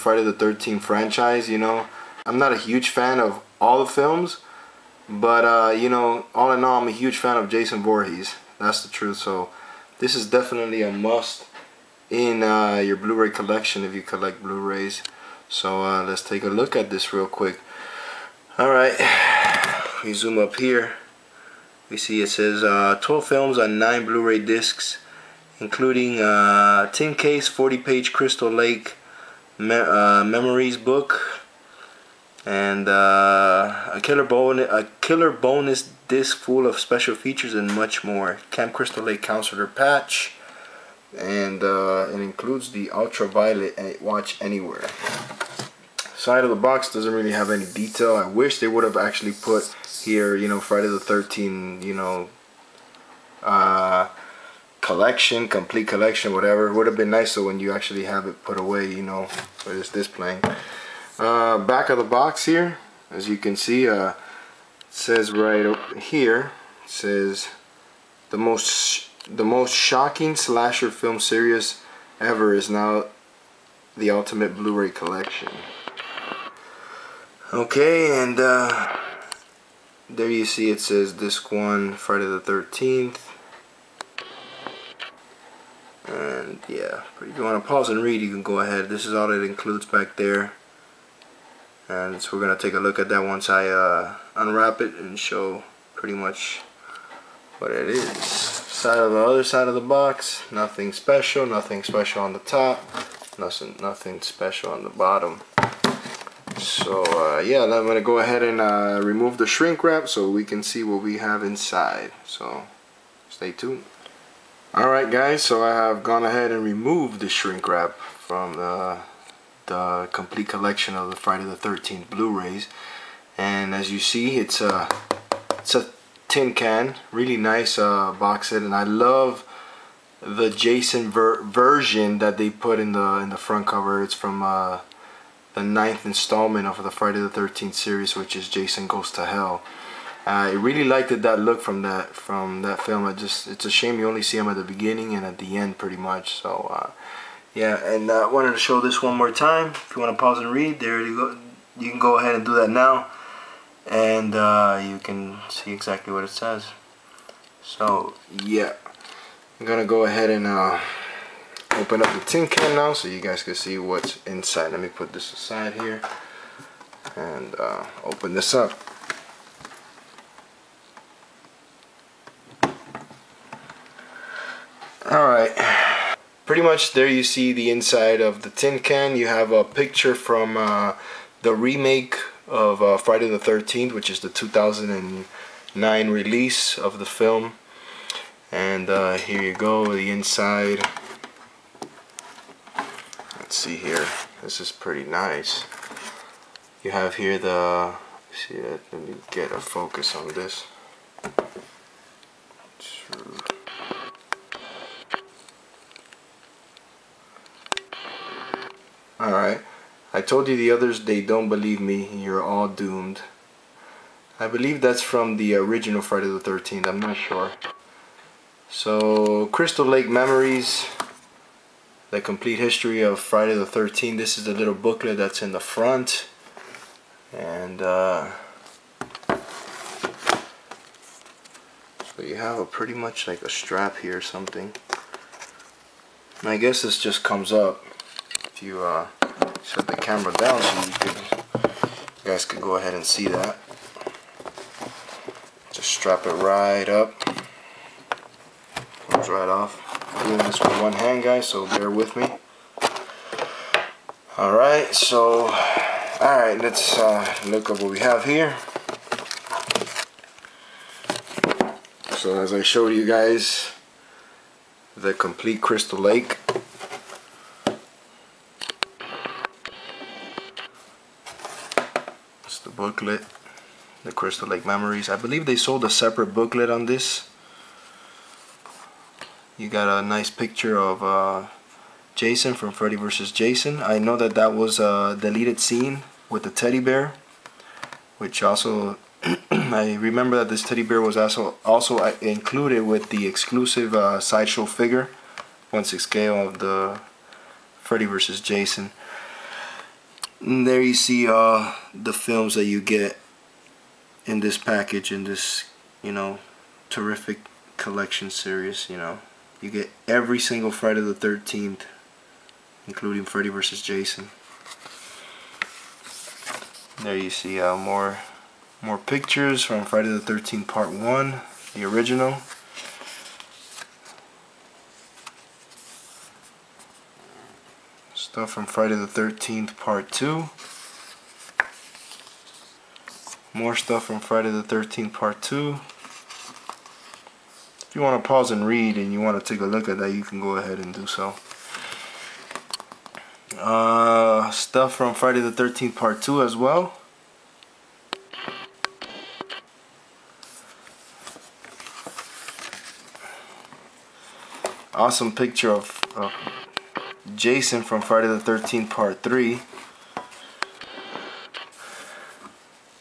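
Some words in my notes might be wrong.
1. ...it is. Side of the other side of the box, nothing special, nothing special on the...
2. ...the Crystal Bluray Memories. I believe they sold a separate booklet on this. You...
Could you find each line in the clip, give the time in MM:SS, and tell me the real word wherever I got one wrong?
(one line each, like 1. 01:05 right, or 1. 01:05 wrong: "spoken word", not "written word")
1. 01:37 right
2. 04:34 wrong: "Lake", not "Bluray".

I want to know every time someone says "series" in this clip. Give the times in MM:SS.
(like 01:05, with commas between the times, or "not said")
01:11, 02:17, 05:08.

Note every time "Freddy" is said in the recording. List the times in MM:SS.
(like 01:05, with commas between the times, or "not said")
04:42, 04:57, 05:13.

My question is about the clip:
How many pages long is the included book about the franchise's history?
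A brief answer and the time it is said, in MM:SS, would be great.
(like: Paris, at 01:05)
40, at 00:27.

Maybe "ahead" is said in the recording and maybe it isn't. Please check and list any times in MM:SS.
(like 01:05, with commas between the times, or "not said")
01:28, 01:48, 01:56, 02:32, 02:40, 04:02, 05:40.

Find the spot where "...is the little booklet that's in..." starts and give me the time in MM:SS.
03:44.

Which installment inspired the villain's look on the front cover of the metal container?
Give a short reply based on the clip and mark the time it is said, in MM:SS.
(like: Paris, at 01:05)
Jason Goes to Hell, at 02:18.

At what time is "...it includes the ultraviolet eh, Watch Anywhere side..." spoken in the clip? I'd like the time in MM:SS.
00:42.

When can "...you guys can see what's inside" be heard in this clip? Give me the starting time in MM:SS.
02:43.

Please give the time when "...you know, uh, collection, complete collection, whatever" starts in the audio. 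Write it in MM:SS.
00:51.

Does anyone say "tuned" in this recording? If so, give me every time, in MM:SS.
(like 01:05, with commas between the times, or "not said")
01:53.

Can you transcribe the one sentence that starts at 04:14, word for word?
Alright, so, alright, let's uh, look at what we have here.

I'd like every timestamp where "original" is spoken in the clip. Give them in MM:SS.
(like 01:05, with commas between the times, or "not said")
03:35, 05:21.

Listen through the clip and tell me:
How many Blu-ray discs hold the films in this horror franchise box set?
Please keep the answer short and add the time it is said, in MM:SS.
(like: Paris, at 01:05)
9, at 00:23.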